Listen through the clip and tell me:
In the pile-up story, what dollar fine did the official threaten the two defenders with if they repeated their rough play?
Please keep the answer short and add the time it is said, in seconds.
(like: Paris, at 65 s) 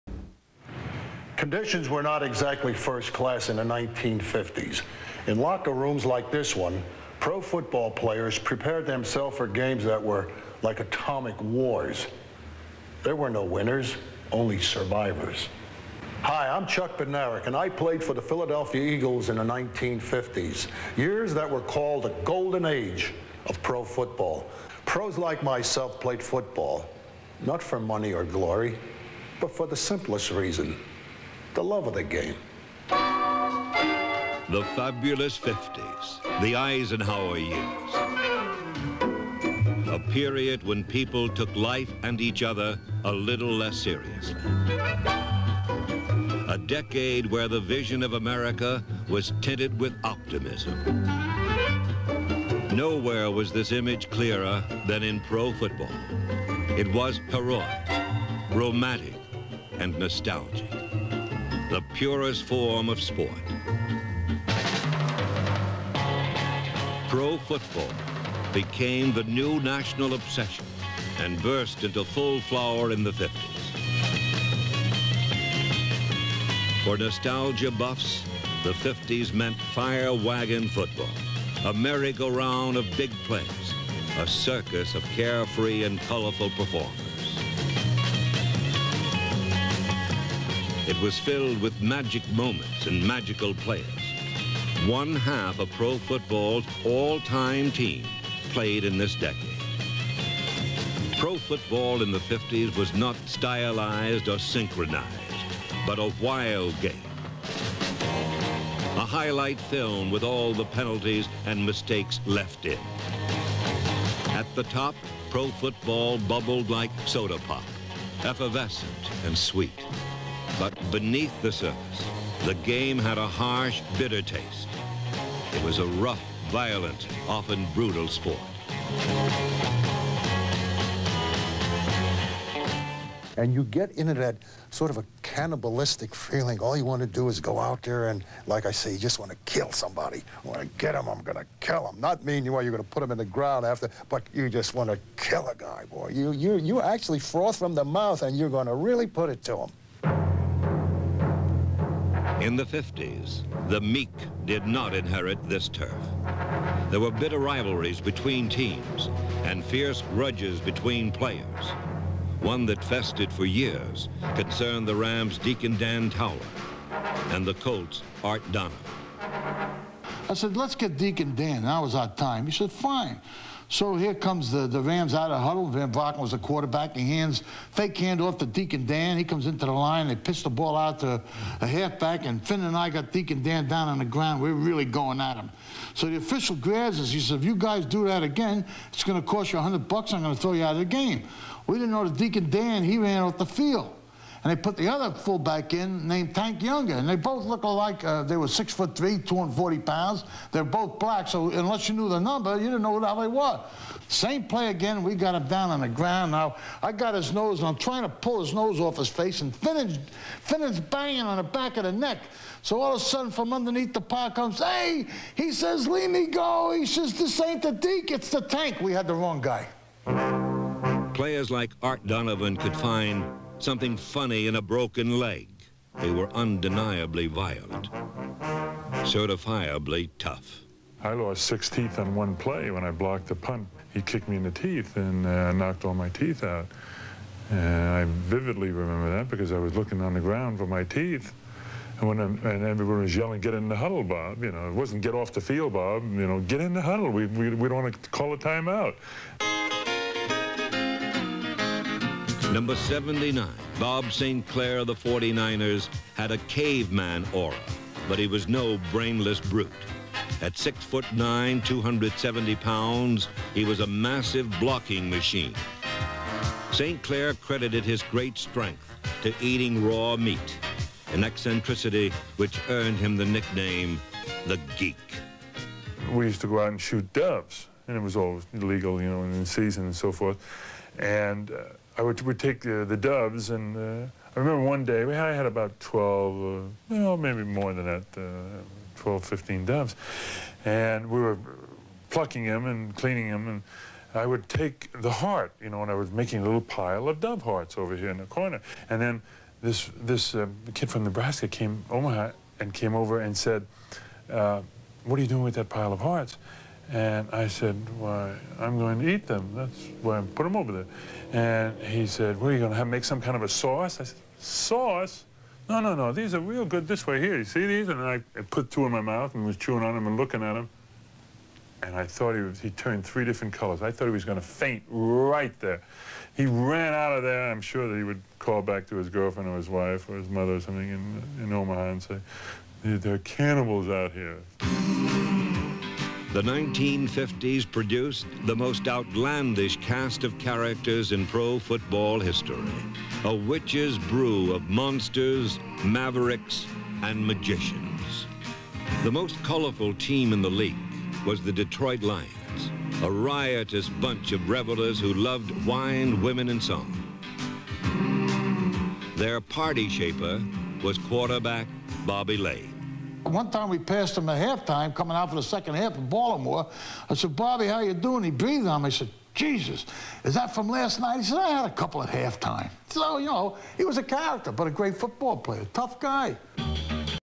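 $100, at 189 s.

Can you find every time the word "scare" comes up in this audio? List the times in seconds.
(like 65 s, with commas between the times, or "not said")
not said.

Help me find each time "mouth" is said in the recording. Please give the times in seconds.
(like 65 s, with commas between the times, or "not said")
147 s, 318 s.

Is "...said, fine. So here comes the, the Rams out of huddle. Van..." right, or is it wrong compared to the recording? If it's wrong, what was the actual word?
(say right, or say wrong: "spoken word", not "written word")
right.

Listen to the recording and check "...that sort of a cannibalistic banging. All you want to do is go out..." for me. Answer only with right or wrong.
wrong.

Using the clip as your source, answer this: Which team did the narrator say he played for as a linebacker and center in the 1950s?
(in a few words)
Philadelphia Eagles.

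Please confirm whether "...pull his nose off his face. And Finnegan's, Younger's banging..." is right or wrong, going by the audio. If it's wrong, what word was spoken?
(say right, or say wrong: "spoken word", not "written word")
wrong: "Finnegan", not "Younger".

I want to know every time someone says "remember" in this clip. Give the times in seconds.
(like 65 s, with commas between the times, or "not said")
238 s, 284 s.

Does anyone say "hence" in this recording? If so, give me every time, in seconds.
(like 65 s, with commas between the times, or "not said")
not said.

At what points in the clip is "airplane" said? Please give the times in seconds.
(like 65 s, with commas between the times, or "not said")
not said.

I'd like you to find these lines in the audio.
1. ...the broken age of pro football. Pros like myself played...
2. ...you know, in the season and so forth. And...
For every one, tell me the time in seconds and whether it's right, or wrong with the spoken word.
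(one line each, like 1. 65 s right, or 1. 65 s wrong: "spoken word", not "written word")
1. 22 s wrong: "golden", not "broken"
2. 279 s right.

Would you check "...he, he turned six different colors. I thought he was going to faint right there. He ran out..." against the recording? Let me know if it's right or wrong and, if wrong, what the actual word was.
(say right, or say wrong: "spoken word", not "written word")
wrong: "three", not "six".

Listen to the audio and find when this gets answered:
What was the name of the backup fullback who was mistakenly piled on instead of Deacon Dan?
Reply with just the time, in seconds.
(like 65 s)
196 s.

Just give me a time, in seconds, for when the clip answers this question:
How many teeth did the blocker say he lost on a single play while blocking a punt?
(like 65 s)
231 s.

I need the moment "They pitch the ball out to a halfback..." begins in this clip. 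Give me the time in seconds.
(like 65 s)
180 s.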